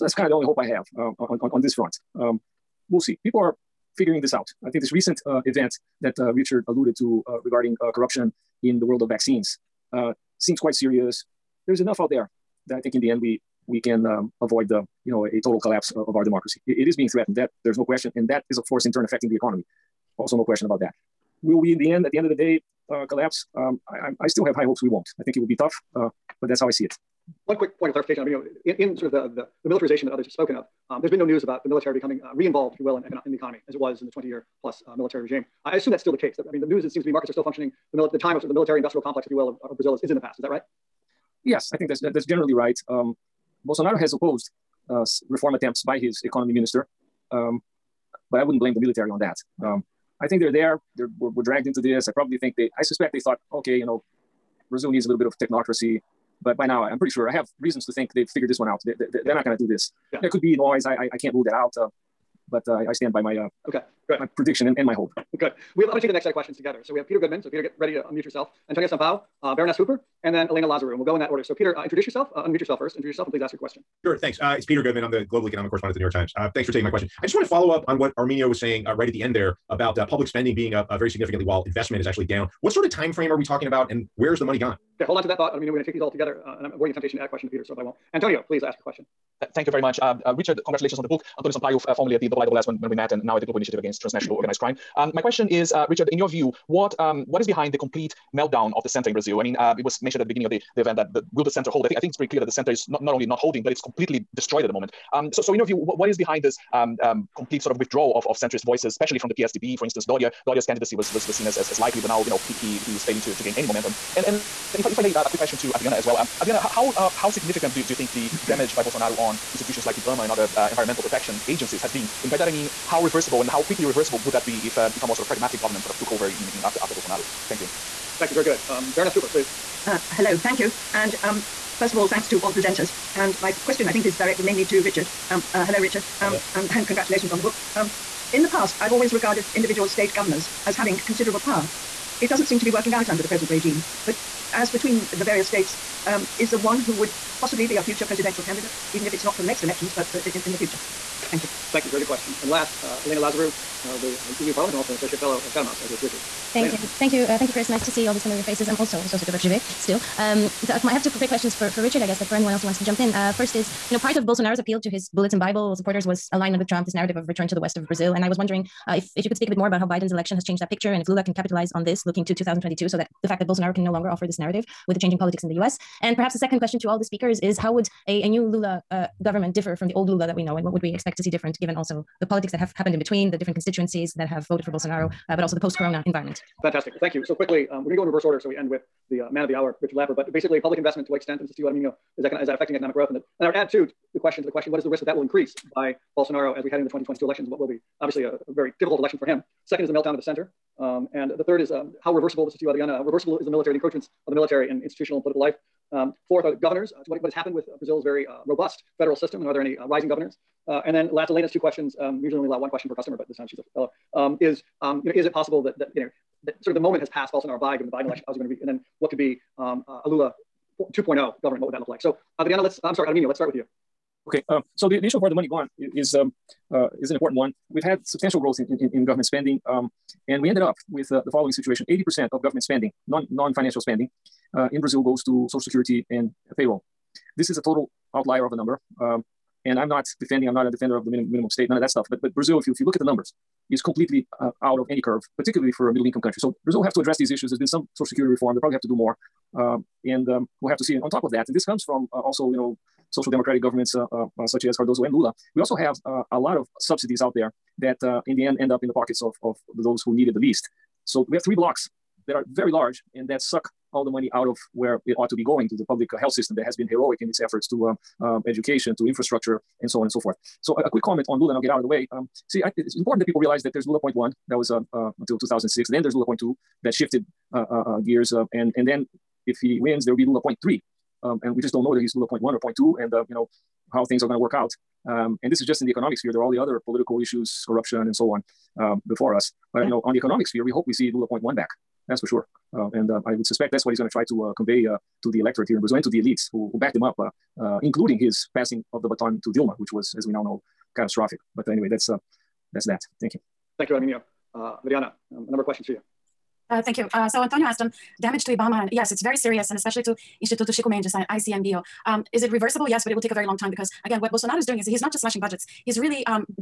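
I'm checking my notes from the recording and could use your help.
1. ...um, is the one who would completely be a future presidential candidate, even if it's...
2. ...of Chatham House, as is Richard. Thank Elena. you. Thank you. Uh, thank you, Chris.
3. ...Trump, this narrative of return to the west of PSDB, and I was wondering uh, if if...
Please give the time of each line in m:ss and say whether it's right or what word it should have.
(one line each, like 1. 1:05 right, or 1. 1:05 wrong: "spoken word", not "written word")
1. 2:26 wrong: "possibly", not "completely"
2. 2:35 right
3. 2:46 wrong: "Brazil", not "PSDB".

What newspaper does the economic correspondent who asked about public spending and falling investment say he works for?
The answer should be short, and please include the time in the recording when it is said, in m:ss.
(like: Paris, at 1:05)
The New York Times, at 1:15.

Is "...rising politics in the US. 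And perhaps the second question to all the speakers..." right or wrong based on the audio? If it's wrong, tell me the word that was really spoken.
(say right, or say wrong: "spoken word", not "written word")
wrong: "changing", not "rising".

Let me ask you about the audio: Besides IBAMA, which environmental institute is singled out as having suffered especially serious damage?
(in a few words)
Instituto Chico Mendes (ICMBio).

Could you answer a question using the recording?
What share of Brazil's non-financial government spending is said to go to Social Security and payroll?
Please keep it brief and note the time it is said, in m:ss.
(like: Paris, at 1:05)
80%, at 3:51.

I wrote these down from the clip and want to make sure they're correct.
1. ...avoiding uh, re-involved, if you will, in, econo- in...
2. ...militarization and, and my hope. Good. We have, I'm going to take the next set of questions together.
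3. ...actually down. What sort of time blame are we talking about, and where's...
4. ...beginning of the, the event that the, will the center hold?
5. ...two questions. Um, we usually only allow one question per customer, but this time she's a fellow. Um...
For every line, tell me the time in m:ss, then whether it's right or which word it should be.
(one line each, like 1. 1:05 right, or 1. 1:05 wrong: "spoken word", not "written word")
1. 0:31 wrong: "becoming", not "avoiding"
2. 1:04 wrong: "prediction", not "militarization"
3. 1:22 wrong: "frame", not "blame"
4. 1:40 right
5. 3:31 right.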